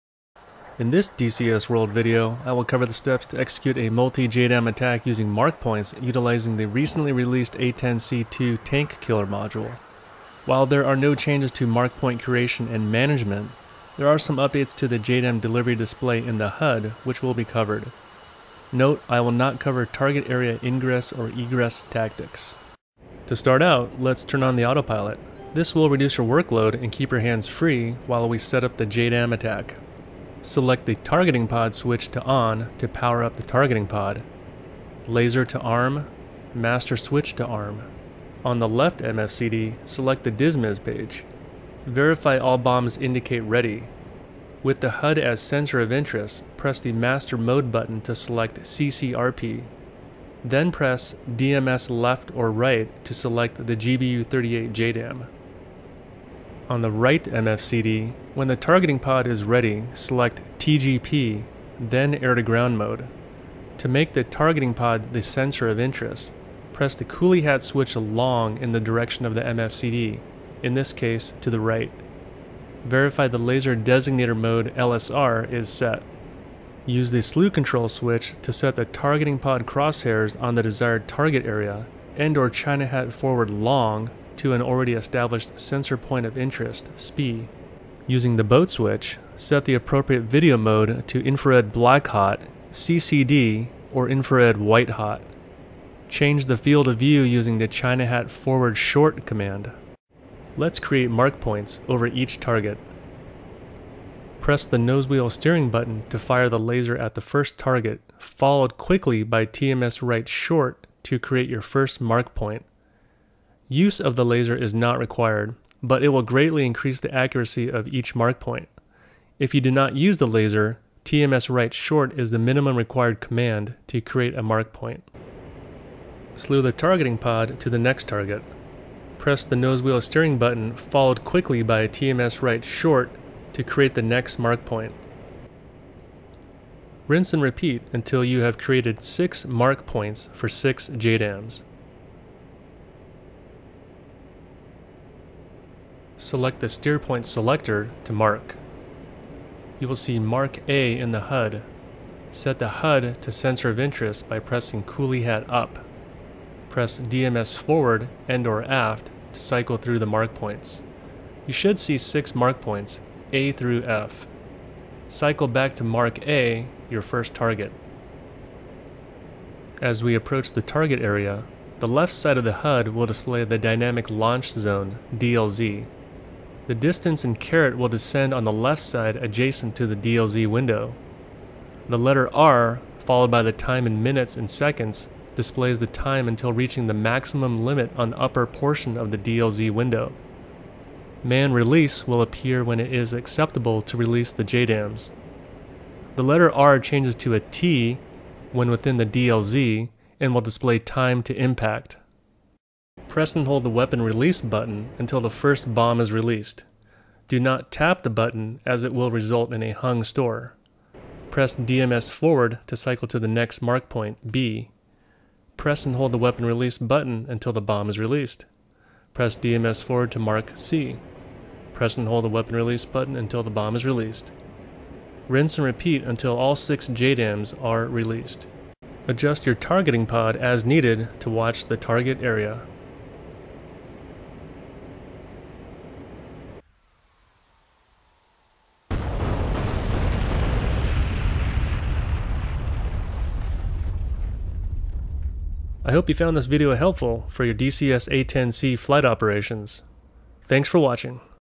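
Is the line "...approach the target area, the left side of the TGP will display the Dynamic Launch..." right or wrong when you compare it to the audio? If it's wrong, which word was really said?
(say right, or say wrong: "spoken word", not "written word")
wrong: "HUD", not "TGP".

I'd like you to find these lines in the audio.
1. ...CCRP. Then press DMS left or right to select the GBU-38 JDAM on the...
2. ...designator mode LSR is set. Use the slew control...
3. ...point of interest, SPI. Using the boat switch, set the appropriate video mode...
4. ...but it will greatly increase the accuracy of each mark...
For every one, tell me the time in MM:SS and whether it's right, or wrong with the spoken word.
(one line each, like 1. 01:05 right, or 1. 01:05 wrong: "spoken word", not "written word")
1. 00:48 right
2. 01:13 right
3. 01:25 right
4. 01:55 right.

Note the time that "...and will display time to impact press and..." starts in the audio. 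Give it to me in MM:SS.
03:20.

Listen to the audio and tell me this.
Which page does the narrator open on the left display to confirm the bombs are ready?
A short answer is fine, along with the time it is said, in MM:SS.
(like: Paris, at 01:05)
DISMIS, at 00:40.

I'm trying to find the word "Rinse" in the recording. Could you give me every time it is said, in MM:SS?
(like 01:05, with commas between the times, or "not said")
02:17, 03:45.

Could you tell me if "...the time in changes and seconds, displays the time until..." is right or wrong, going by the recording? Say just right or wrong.
wrong.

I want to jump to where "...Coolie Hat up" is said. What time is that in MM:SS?
02:34.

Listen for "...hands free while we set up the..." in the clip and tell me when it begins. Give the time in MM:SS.
00:27.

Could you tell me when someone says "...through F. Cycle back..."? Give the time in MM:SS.
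02:43.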